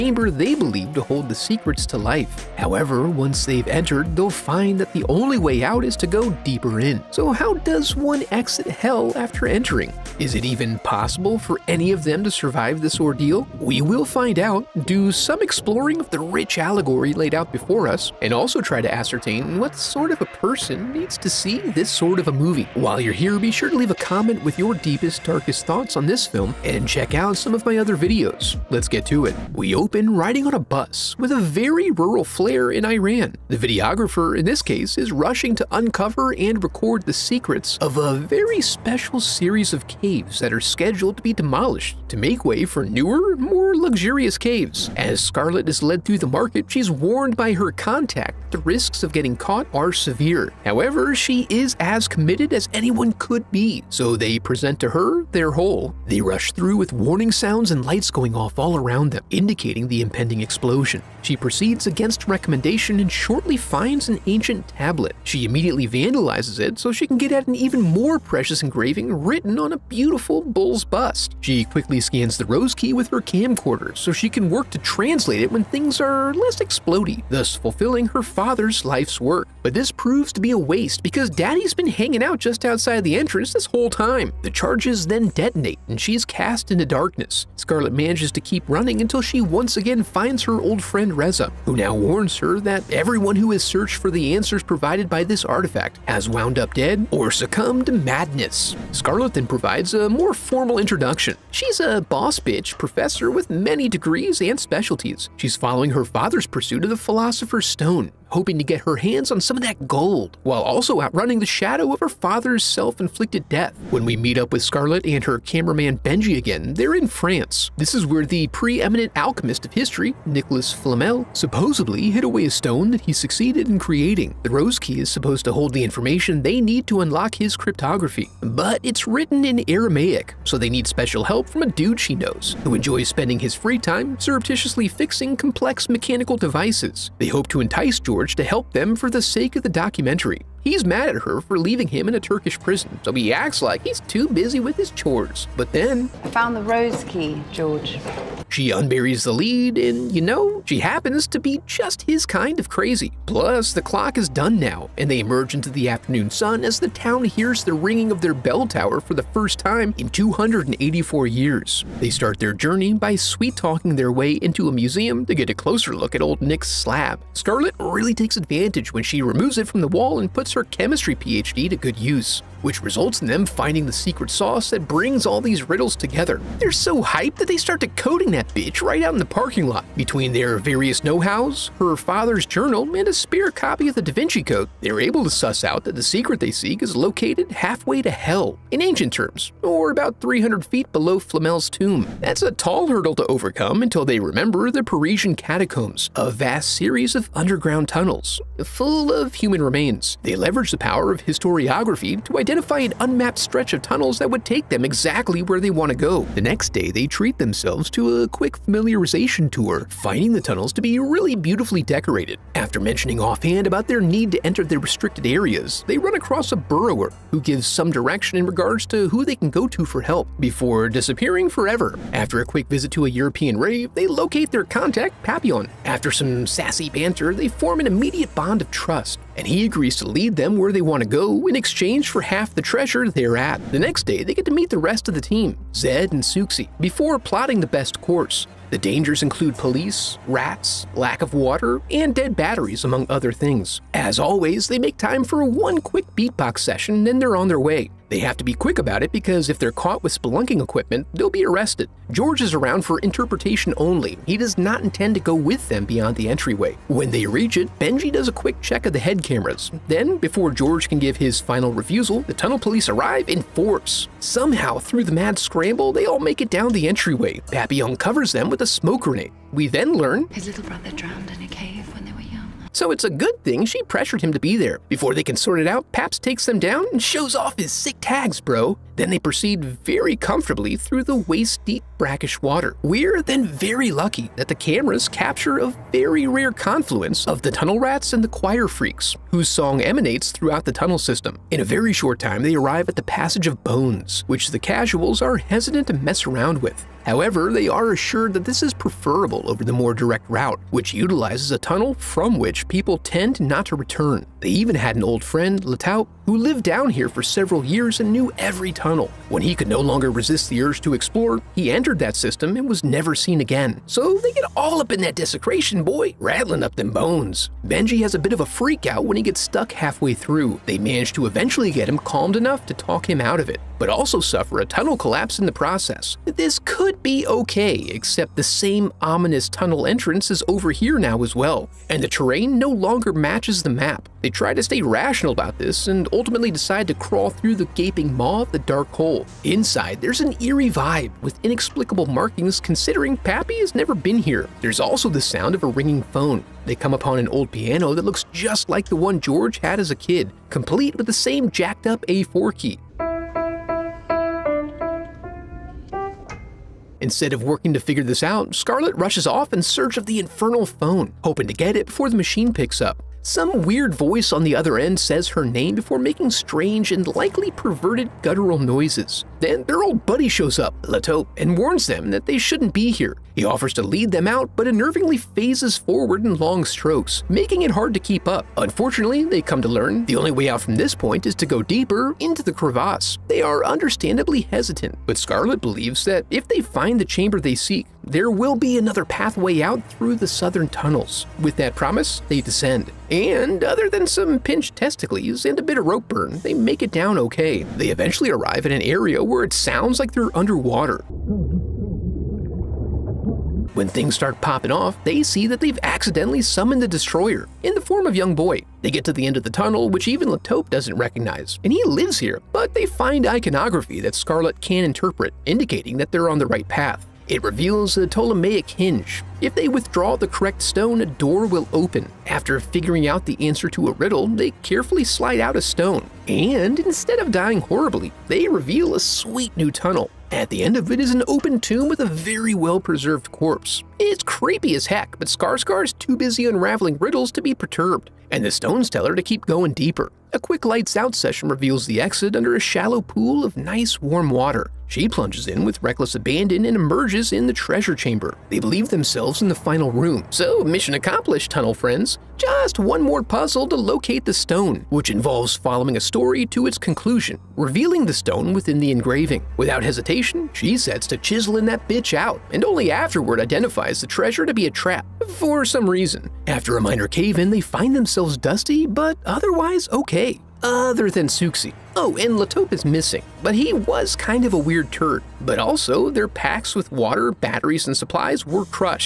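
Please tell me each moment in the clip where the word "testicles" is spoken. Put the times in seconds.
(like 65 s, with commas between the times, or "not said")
394 s.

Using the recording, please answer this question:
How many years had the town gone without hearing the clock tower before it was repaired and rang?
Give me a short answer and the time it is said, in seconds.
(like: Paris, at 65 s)
284, at 160 s.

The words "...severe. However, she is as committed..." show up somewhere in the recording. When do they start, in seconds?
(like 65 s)
49 s.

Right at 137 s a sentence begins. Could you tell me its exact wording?
They hope to entice George George to help them for the sake of the documentary.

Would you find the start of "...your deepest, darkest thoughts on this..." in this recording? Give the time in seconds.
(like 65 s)
24 s.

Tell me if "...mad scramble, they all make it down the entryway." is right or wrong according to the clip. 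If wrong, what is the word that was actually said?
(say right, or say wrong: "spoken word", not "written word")
right.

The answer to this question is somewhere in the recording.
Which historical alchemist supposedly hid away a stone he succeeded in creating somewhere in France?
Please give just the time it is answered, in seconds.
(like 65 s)
120 s.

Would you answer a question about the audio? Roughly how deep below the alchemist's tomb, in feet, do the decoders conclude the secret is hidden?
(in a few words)
300 feet.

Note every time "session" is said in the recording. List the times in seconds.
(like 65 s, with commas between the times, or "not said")
246 s, 441 s.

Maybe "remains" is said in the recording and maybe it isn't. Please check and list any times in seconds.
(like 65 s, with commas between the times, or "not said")
199 s.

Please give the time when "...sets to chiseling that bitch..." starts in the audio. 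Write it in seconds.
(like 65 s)
460 s.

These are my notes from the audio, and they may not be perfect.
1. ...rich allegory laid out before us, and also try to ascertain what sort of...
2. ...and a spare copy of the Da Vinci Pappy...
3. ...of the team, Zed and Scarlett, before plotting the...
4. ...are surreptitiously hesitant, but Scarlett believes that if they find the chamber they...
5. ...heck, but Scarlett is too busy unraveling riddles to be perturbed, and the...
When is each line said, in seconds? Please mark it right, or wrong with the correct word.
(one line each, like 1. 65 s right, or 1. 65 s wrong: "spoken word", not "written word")
1. 16 s right
2. 182 s wrong: "Code", not "Pappy"
3. 235 s wrong: "Souxie", not "Scarlett"
4. 383 s wrong: "understandably", not "surreptitiously"
5. 434 s right.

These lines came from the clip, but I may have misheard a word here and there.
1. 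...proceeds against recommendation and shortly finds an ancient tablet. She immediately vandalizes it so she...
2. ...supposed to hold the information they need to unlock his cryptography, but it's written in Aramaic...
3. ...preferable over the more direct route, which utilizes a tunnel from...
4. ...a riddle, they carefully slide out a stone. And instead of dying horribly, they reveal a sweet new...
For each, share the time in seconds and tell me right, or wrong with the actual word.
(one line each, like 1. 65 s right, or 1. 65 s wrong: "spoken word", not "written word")
1. 61 s right
2. 125 s right
3. 298 s right
4. 423 s right.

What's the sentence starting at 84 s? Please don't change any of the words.
The charges then detonate and she's cast into darkness.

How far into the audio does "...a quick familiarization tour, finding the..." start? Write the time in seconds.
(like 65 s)
208 s.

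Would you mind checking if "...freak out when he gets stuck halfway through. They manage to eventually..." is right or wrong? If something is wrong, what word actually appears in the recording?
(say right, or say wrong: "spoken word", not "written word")
right.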